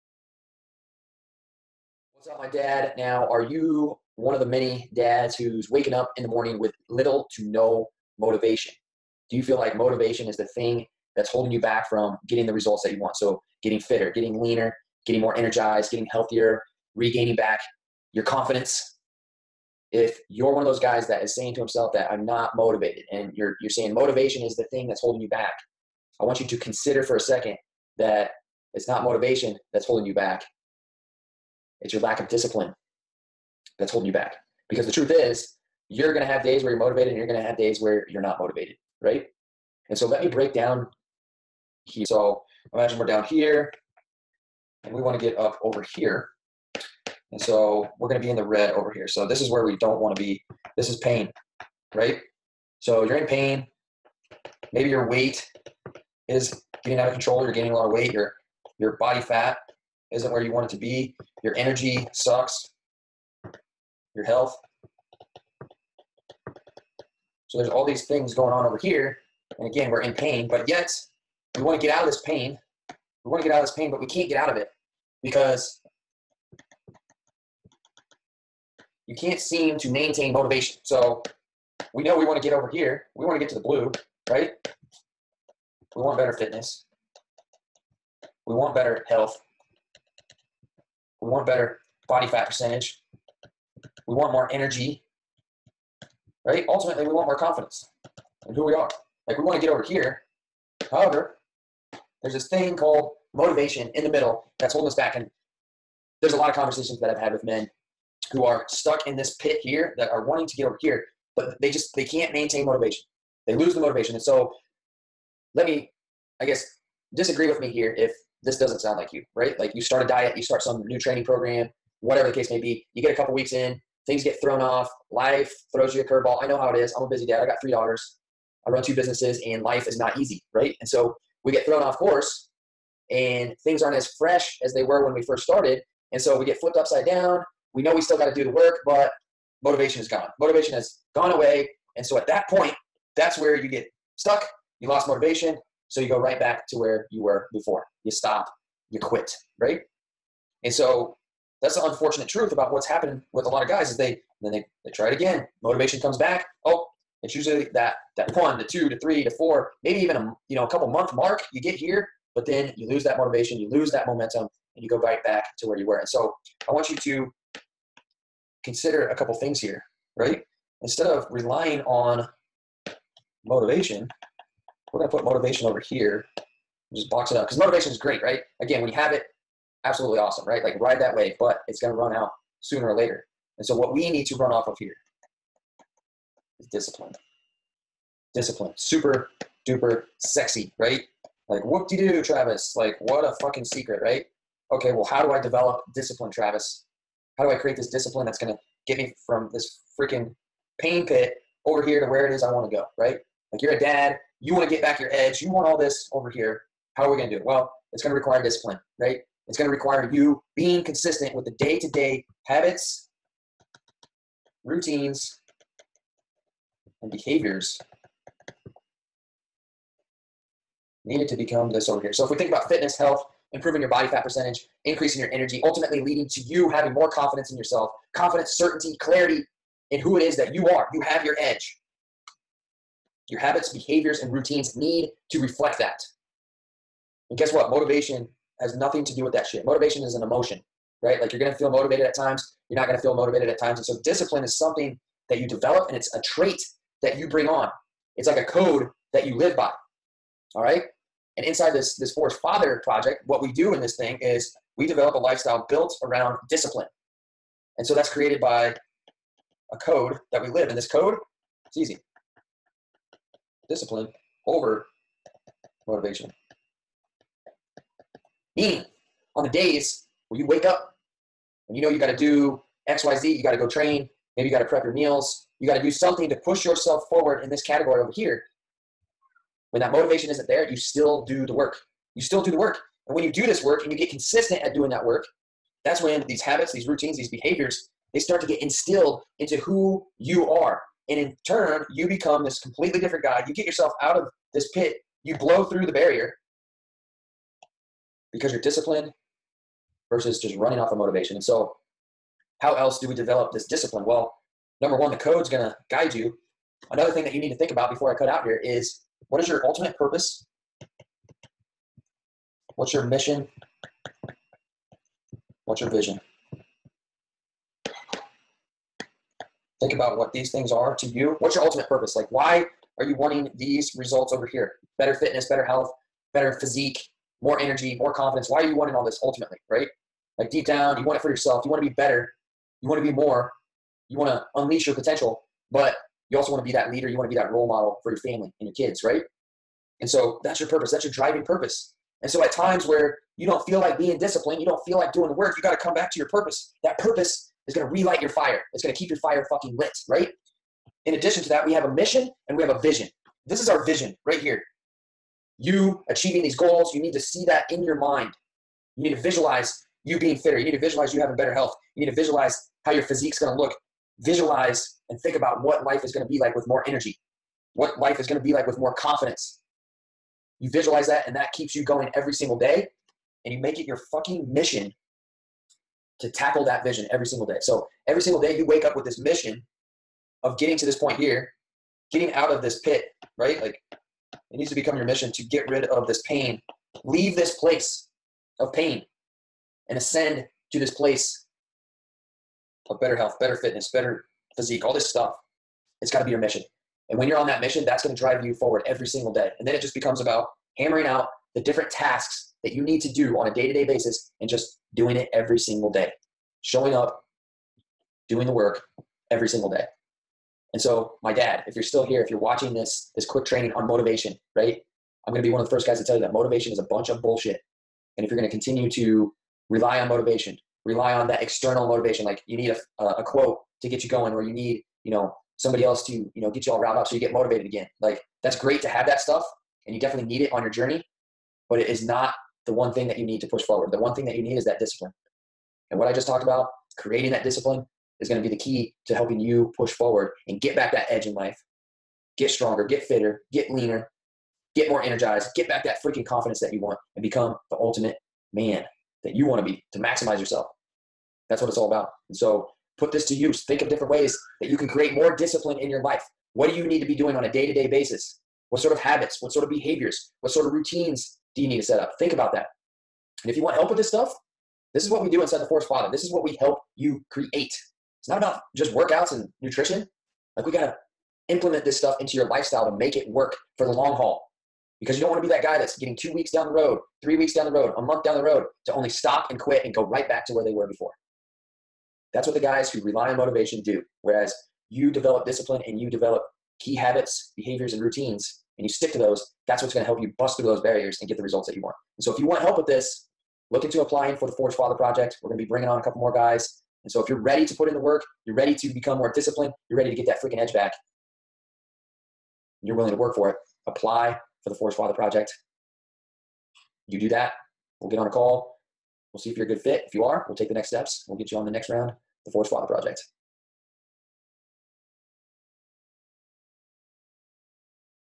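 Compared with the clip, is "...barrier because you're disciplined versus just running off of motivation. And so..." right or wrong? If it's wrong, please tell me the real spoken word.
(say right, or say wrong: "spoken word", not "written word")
right.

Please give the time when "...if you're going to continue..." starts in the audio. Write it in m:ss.
6:58.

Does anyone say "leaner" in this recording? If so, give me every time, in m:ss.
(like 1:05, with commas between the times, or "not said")
0:14, 7:23.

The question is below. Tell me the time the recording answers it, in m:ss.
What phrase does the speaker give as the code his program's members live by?
4:23.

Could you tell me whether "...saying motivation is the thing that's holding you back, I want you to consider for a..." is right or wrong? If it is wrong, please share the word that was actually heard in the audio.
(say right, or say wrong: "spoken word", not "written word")
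right.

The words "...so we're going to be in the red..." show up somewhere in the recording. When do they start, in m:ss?
0:47.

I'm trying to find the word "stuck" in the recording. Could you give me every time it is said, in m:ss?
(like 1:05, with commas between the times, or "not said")
1:48, 2:24.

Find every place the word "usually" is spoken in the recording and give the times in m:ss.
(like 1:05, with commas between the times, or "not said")
2:37.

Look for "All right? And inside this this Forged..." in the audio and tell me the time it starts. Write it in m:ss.
4:10.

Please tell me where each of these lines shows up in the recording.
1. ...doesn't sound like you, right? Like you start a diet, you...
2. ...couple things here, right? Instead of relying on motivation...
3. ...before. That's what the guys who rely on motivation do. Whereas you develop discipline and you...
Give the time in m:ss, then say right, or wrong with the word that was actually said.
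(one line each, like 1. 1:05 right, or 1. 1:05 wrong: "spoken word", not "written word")
1. 1:58 right
2. 2:49 right
3. 8:00 right.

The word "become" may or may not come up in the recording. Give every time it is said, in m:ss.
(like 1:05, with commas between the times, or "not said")
3:41, 4:52, 6:24, 6:39, 7:27, 8:18.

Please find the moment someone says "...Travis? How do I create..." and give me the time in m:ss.
3:16.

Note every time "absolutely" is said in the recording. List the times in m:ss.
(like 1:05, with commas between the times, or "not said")
2:59.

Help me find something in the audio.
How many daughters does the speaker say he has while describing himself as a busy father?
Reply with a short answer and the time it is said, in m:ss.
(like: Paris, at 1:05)
3, at 2:07.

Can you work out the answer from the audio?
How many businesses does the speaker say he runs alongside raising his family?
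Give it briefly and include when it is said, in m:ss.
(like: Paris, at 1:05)
2, at 2:08.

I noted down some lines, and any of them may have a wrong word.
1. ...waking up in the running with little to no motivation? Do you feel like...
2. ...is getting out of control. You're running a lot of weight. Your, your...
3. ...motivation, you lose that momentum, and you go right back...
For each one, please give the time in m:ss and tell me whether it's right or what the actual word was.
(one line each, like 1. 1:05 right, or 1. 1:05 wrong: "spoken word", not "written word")
1. 0:05 wrong: "morning", not "running"
2. 0:56 wrong: "gaining", not "running"
3. 2:43 right.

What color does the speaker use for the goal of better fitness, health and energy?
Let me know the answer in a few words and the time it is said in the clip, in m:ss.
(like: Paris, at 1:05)
Blue, at 1:23.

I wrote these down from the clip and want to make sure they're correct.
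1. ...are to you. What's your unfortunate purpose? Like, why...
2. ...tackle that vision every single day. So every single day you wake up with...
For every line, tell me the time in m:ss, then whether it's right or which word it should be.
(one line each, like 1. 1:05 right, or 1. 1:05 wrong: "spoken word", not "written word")
1. 5:20 wrong: "ultimate", not "unfortunate"
2. 6:16 right.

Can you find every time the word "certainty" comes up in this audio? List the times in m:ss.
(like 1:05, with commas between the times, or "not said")
3:48.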